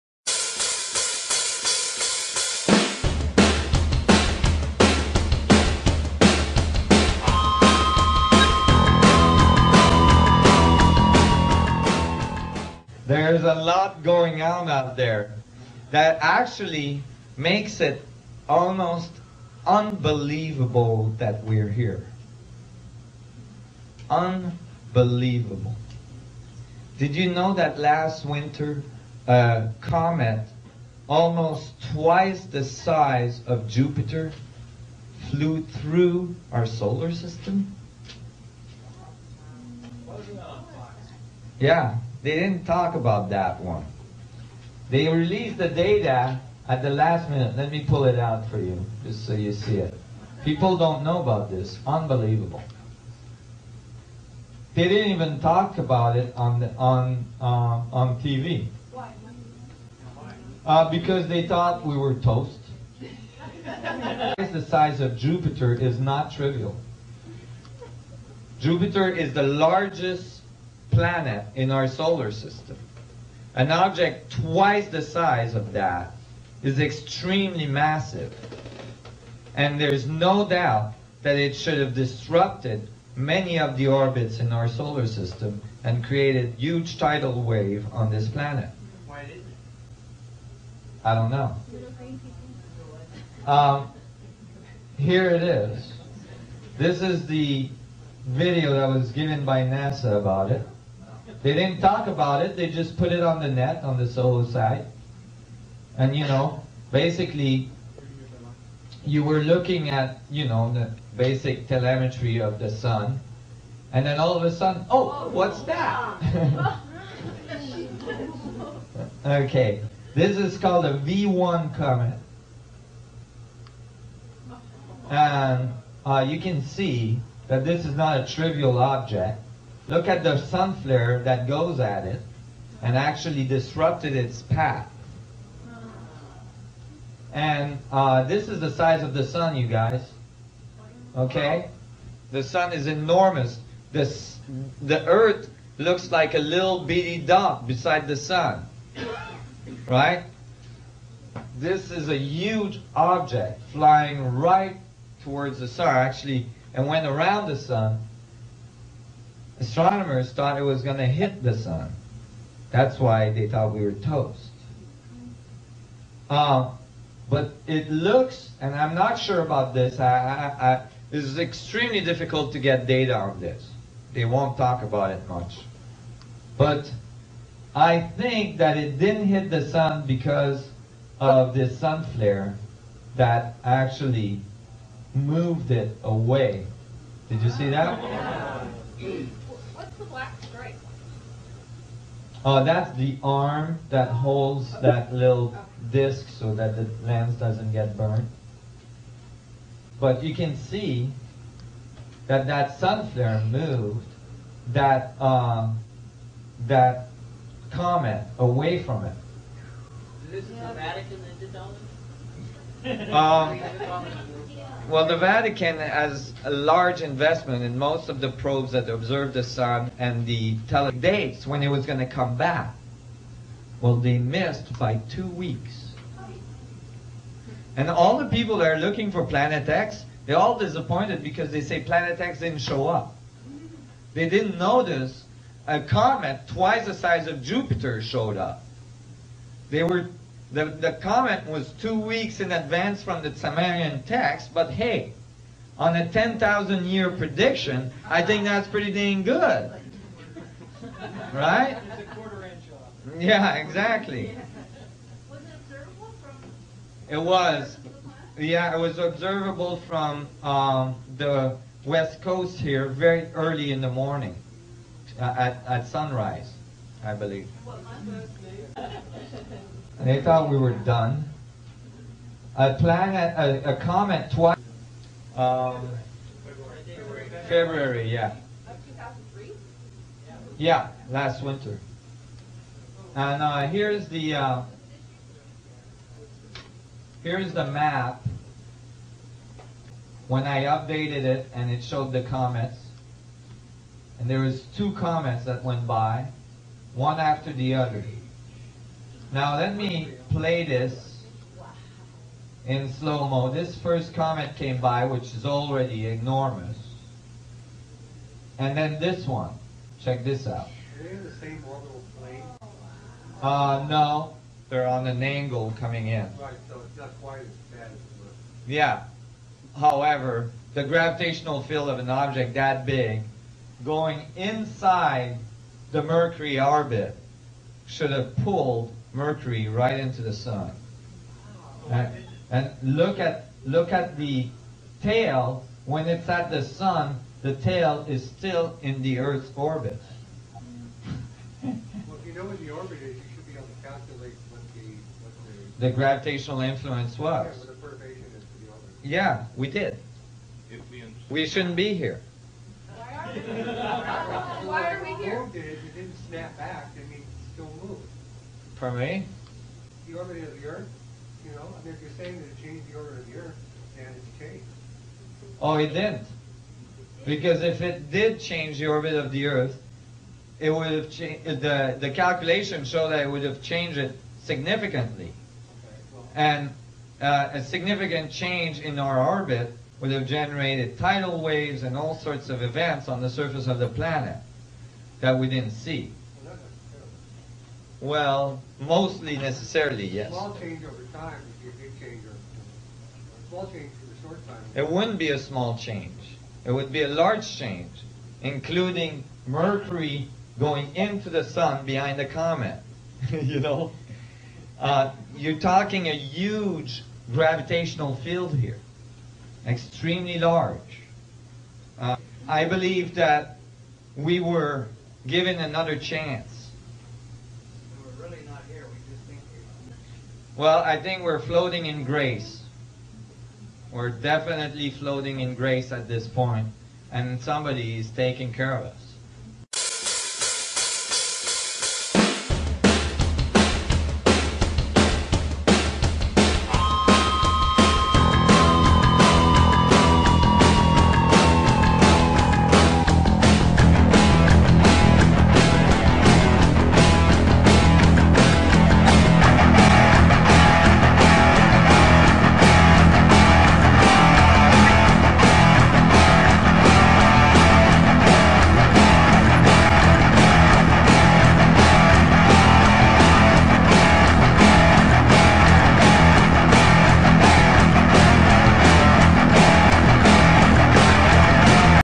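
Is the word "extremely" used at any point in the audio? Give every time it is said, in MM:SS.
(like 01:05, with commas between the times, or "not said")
01:16, 02:51, 06:49.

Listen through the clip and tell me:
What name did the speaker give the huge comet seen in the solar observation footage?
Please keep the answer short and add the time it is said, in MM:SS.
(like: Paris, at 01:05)
V1 comet, at 02:00.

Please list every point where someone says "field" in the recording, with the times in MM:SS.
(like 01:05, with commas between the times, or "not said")
05:21, 06:48.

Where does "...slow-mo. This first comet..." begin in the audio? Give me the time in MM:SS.
05:02.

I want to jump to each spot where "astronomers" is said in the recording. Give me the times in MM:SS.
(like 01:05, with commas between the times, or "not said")
02:39.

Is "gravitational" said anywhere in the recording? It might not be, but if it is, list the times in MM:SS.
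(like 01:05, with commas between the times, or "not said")
05:20, 05:45, 06:47.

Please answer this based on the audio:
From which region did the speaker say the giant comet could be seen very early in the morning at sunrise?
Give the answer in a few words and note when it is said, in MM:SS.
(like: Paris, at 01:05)
West coast, at 04:21.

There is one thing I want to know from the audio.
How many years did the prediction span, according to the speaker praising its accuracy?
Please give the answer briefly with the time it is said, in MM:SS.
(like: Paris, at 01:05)
10,000 years, at 04:06.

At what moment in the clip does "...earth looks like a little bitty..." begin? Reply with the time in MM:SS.
02:25.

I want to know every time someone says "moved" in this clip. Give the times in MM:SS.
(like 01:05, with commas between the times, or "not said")
03:05, 03:23, 05:57.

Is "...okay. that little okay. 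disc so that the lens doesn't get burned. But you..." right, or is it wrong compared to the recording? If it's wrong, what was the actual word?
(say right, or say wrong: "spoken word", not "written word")
right.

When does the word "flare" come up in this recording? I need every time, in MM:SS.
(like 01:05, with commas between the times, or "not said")
02:10, 03:02, 03:23.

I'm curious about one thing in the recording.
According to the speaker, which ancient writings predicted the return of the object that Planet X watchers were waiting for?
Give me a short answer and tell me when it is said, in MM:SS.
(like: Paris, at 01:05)
Sumerian text, at 04:03.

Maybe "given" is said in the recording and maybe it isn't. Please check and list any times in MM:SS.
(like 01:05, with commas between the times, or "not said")
01:39, 06:55.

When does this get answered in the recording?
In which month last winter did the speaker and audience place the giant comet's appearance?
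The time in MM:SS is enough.
04:37.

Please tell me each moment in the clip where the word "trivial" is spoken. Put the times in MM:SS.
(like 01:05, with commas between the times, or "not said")
01:06, 02:08.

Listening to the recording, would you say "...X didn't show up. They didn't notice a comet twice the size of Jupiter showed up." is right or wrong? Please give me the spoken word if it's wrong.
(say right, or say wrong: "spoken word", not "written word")
right.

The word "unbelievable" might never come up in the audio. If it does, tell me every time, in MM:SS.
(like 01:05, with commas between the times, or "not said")
00:19, 00:24, 00:51.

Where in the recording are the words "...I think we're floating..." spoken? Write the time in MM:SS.
07:00.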